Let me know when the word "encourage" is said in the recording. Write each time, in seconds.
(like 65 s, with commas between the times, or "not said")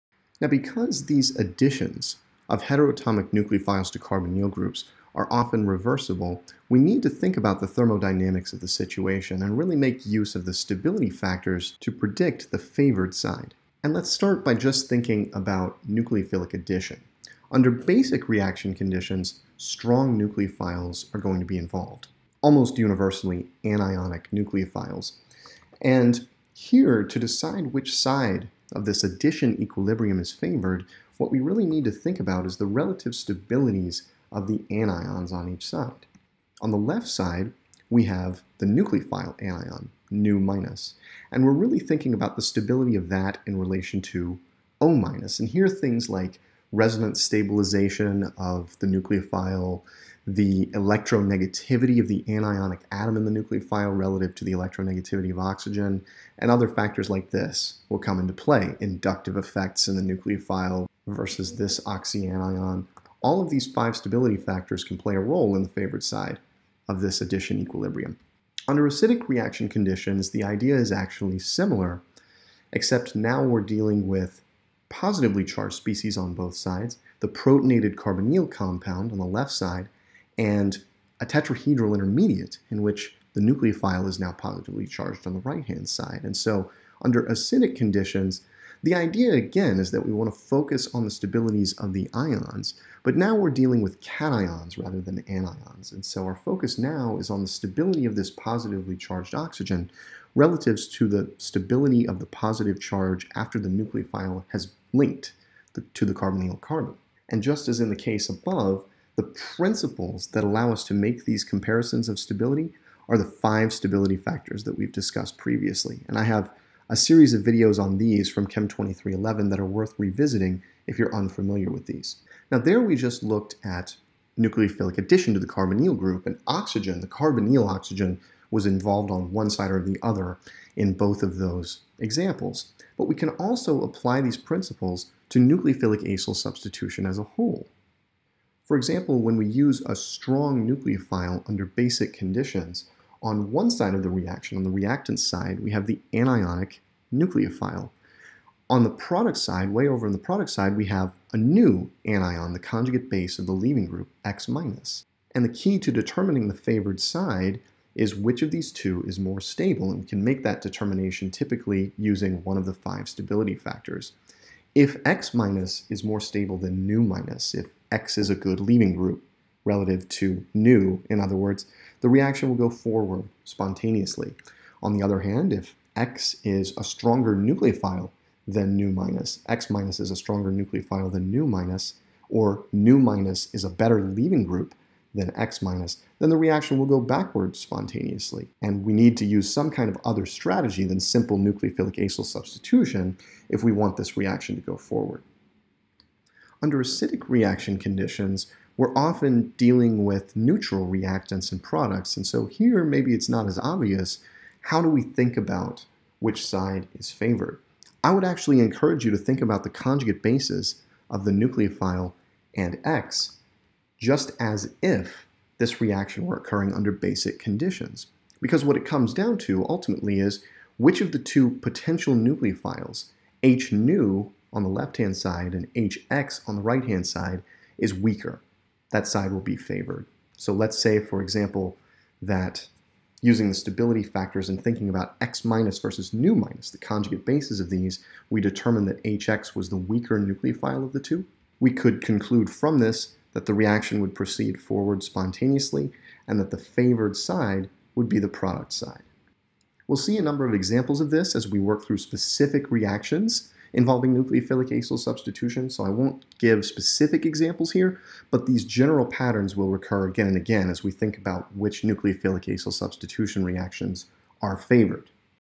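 208 s.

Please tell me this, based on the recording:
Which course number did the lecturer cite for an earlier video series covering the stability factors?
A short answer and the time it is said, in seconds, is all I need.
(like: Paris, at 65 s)
Chem 2311, at 118 s.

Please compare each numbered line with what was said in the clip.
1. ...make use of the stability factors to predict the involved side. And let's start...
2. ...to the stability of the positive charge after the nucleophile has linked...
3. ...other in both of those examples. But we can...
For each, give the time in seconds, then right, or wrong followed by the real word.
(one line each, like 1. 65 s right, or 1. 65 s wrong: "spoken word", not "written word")
1. 9 s wrong: "favored", not "involved"
2. 100 s right
3. 130 s right.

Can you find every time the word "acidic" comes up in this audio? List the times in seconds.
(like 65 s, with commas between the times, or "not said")
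68 s, 87 s, 196 s.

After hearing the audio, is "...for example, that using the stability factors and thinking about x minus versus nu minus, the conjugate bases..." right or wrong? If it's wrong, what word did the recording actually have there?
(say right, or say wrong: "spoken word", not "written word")
right.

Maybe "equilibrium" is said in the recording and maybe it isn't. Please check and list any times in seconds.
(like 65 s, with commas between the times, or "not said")
29 s, 67 s.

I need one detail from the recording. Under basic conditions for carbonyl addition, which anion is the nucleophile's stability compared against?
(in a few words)
O minus.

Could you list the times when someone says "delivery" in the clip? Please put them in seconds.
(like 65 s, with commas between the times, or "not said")
not said.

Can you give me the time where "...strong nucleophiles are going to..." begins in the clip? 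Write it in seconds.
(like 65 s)
19 s.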